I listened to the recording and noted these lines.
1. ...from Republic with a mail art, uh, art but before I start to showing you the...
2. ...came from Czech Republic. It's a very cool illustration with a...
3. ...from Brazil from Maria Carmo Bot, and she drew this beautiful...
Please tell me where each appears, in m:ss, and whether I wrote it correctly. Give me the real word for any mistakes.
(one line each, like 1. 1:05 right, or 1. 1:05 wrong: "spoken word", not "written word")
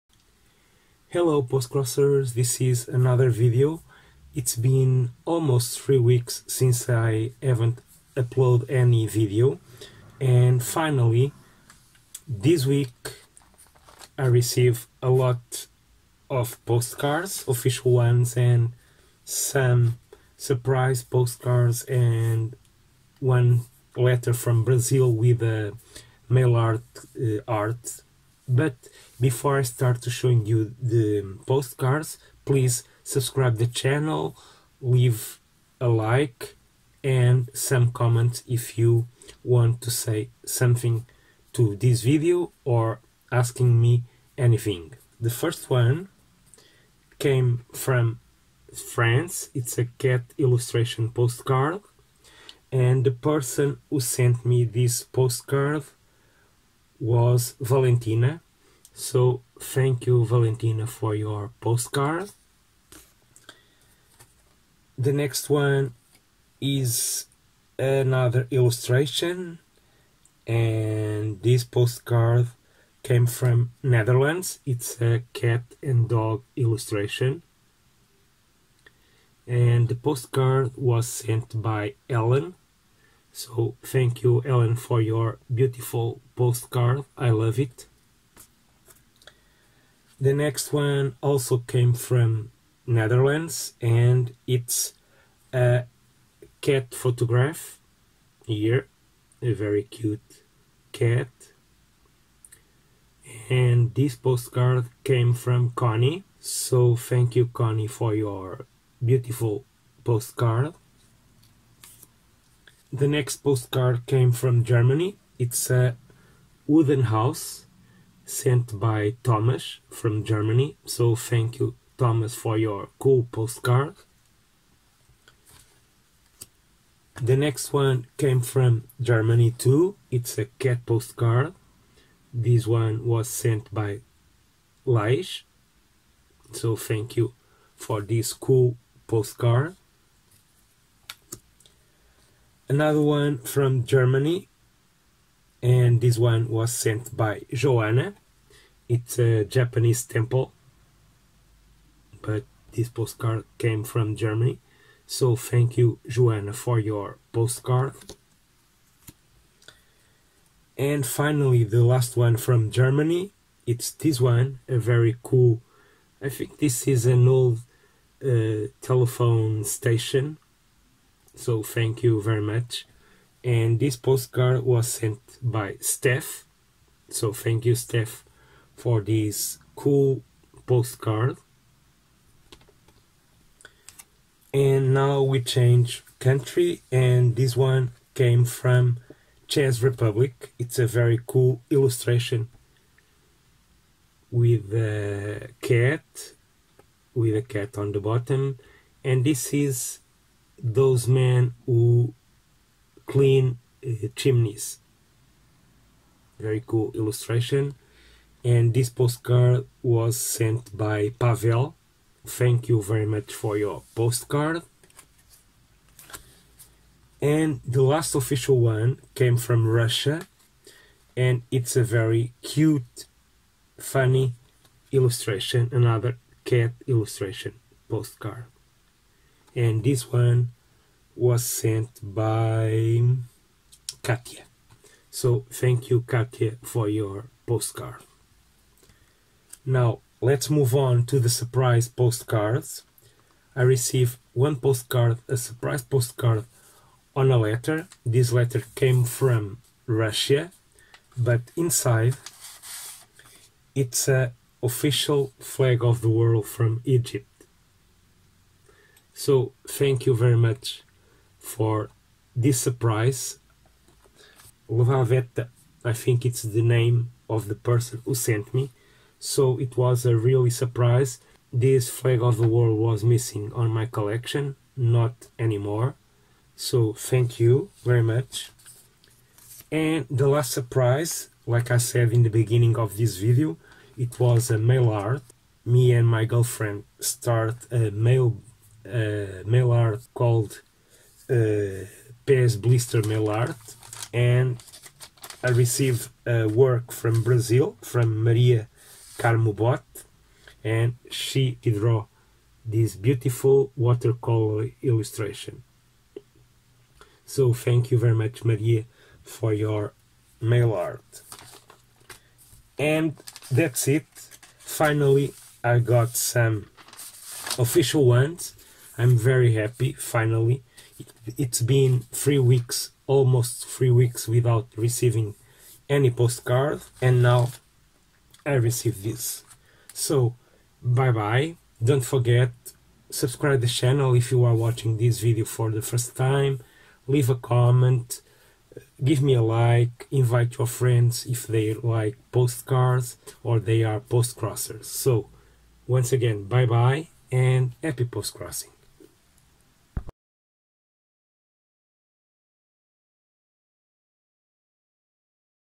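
1. 0:24 wrong: "Brazil", not "Republic"
2. 3:08 right
3. 4:56 right.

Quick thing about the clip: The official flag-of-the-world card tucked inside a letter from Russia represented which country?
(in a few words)
Egypt.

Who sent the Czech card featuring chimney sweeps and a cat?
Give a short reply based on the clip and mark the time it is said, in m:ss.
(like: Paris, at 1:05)
Pavel, at 3:31.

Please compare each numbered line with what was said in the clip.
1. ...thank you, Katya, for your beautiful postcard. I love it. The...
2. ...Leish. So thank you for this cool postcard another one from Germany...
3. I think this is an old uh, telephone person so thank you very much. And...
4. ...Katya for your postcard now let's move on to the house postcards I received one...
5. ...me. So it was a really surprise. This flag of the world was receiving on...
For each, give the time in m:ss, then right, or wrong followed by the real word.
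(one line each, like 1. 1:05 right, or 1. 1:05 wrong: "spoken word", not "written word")
1. 1:23 wrong: "Ellen", not "Katya"
2. 2:14 right
3. 2:46 wrong: "station", not "person"
4. 3:56 wrong: "surprise", not "house"
5. 4:28 wrong: "missing", not "receiving".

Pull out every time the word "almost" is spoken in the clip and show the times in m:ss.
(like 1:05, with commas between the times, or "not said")
0:05, 5:23.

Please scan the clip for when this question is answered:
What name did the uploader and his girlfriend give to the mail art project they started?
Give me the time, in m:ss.
4:52.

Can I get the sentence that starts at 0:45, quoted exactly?
The first one came from France.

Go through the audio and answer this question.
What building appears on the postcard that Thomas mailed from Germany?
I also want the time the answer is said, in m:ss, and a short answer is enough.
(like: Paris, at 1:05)
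wooden house, at 1:56.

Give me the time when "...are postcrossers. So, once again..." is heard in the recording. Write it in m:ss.
5:43.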